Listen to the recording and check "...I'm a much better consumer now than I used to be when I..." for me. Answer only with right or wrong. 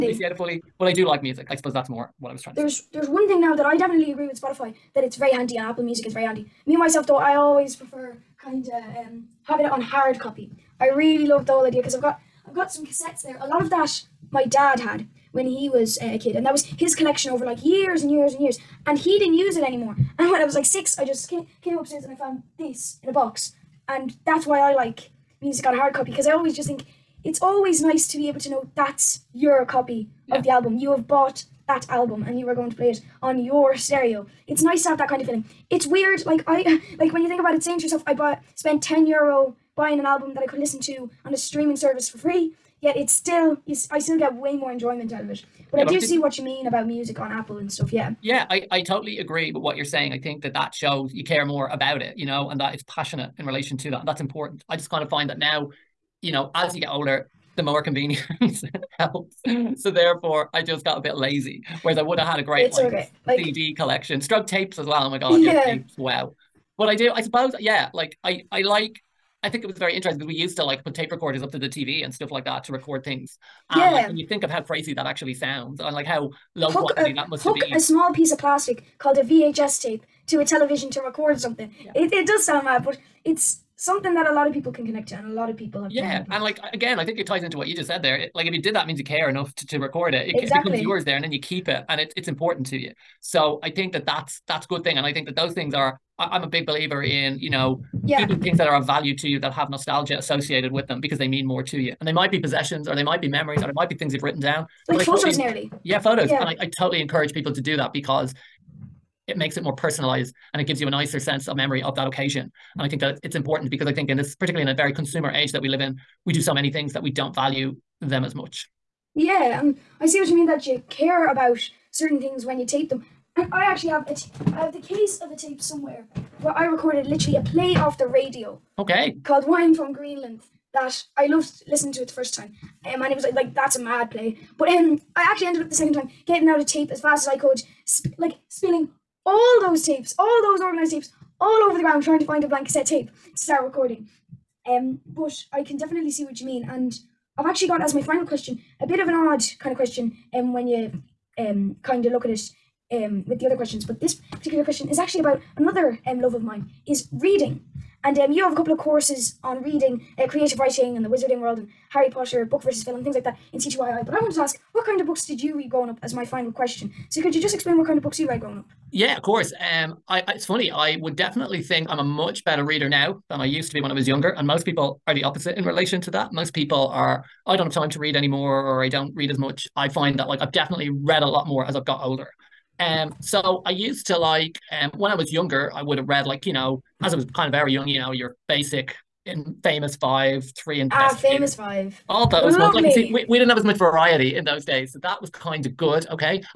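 wrong.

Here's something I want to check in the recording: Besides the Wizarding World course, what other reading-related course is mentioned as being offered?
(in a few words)
Creative writing.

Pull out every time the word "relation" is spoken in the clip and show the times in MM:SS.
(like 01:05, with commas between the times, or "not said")
00:53, 02:55.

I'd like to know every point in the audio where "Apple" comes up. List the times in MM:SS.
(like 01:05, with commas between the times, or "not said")
00:05, 00:47.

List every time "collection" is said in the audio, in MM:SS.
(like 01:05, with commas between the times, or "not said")
00:16, 01:03.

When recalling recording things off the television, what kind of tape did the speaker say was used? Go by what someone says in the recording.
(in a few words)
VHS tape.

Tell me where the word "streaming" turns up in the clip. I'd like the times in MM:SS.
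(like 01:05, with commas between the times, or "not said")
00:41.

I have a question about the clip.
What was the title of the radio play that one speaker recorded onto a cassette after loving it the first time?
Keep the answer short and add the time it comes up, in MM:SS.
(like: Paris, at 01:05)
Wine from Greenland, at 02:09.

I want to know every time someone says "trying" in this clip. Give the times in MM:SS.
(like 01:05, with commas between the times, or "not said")
00:02, 02:22.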